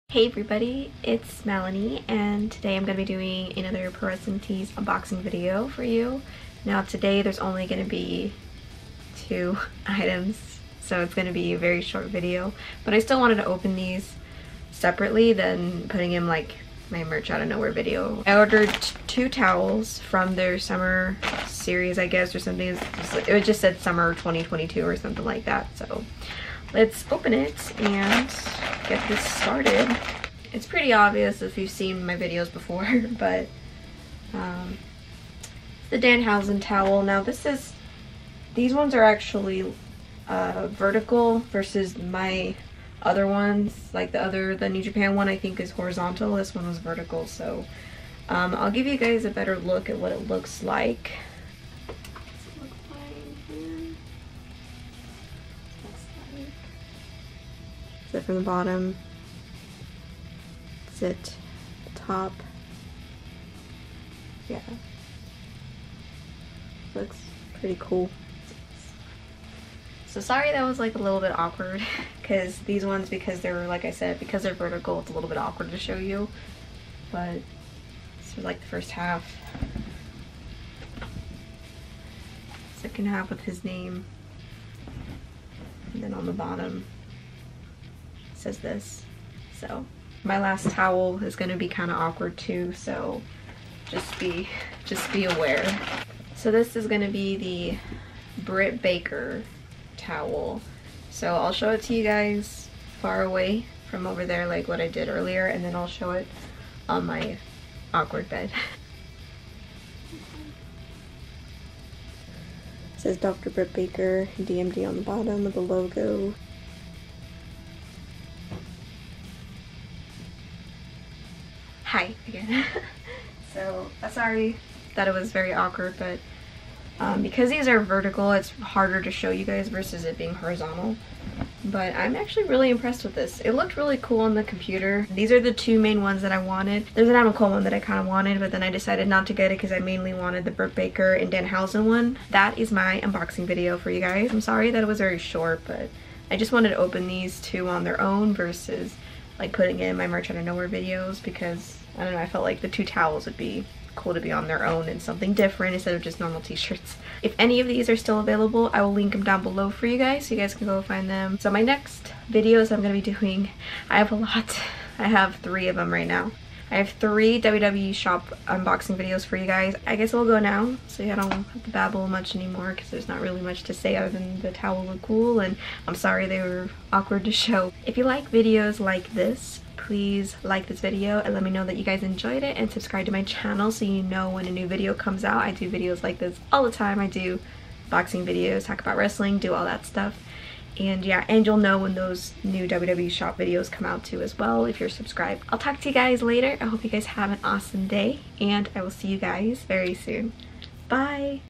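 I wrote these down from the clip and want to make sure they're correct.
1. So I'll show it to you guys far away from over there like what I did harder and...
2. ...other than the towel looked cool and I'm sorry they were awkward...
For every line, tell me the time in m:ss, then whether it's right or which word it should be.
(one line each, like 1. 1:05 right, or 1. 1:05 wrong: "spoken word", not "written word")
1. 1:41 wrong: "earlier", not "harder"
2. 2:53 right.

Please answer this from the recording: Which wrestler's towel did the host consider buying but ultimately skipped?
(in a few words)
Adam Cole.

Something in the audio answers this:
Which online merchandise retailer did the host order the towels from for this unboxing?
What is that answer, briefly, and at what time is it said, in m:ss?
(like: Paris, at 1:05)
Pro Wrestling Tees, at 0:03.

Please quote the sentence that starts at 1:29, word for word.
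So my last towel is gonna be kind of awkward too, so just be, just be aware.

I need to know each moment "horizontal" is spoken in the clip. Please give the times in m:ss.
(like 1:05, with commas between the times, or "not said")
0:45, 2:10.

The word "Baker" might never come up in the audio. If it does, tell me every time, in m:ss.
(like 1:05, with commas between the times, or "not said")
1:38, 1:53, 2:20.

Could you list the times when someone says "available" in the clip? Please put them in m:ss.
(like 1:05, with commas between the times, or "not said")
2:38.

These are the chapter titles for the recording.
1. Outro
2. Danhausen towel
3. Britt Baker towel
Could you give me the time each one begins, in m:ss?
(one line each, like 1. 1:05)
1. 2:22
2. 0:30
3. 1:36.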